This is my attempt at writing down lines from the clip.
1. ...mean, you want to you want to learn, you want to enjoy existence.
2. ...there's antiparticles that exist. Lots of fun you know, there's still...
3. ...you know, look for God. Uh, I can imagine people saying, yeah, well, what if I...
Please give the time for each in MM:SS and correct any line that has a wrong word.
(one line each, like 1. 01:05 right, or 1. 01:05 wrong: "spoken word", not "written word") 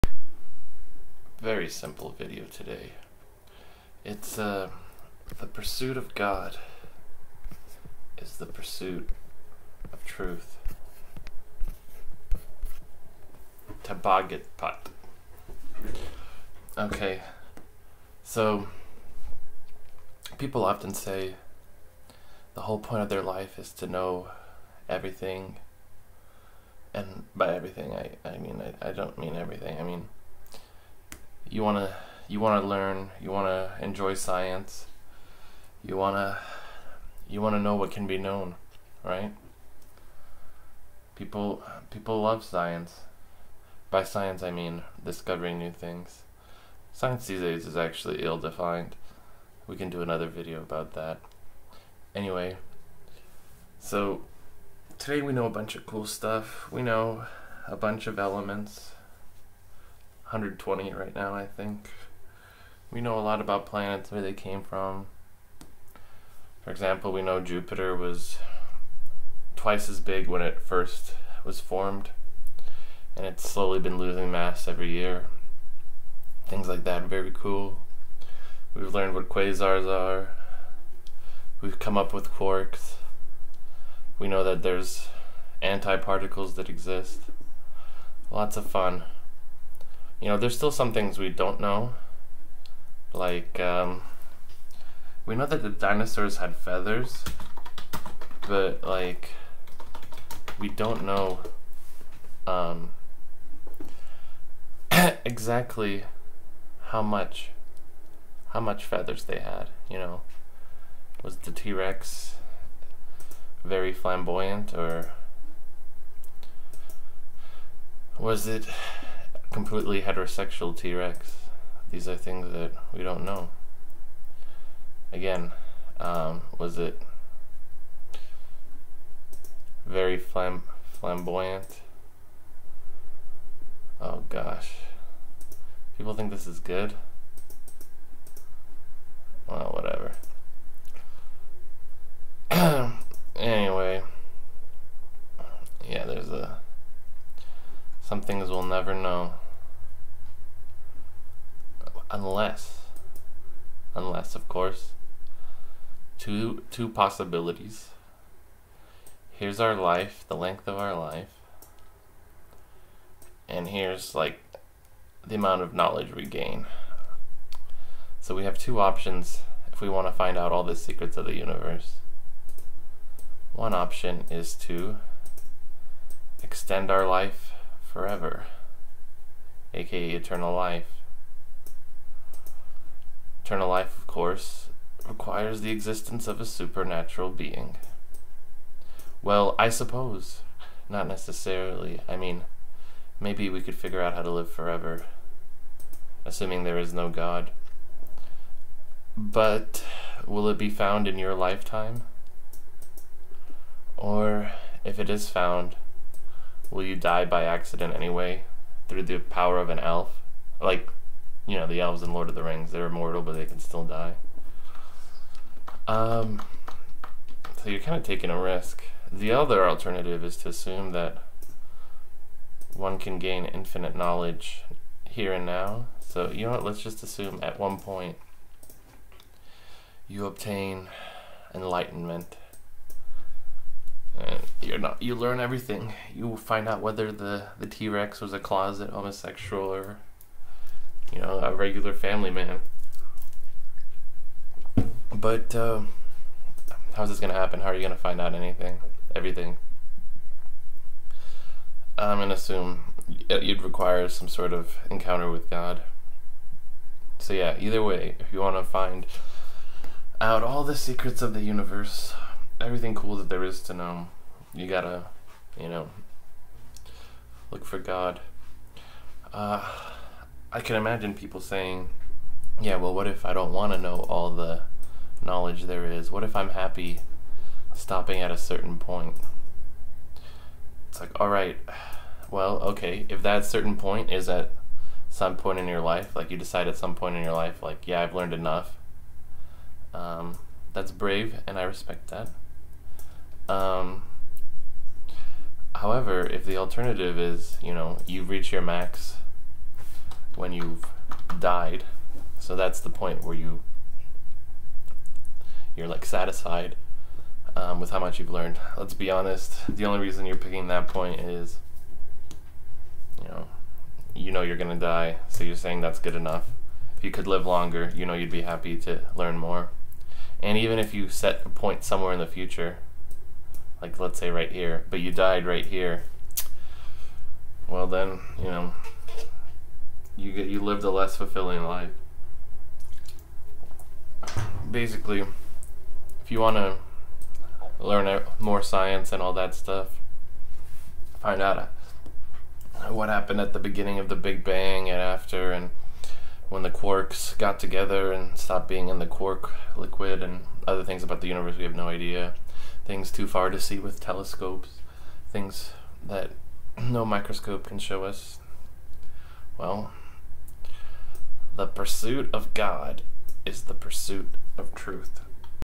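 1. 00:29 wrong: "science", not "existence"
2. 01:24 right
3. 04:25 right.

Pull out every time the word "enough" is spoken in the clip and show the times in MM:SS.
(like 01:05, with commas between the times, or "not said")
04:48, 05:16.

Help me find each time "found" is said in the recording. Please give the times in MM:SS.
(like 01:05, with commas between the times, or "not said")
03:20, 03:25.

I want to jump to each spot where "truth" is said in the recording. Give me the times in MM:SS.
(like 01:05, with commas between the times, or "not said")
00:10, 06:04.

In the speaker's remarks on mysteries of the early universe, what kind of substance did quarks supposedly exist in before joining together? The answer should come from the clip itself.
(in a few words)
Quark liquid.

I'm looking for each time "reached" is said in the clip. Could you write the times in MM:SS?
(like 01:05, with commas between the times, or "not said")
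04:58.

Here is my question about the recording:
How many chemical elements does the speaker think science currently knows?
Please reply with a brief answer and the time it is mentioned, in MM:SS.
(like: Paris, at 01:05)
120, at 01:00.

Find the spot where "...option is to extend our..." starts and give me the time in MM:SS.
02:53.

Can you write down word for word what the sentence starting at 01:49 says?
You know, was the T Rex very flamboyant, or was it completely heterosexual T Rex.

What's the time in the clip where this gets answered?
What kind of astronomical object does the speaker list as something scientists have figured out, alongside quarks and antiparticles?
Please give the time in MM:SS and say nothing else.
01:19.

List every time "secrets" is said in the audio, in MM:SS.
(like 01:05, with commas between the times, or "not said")
02:50, 04:20.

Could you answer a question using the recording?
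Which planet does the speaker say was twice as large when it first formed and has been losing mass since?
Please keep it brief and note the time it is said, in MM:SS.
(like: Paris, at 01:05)
Jupiter, at 01:07.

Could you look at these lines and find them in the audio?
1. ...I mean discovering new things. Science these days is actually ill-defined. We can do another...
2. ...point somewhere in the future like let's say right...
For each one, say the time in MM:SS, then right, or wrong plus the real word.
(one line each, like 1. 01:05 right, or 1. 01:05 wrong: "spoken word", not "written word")
1. 00:44 right
2. 05:21 right.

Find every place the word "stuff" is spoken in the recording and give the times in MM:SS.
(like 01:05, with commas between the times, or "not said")
00:56, 05:39.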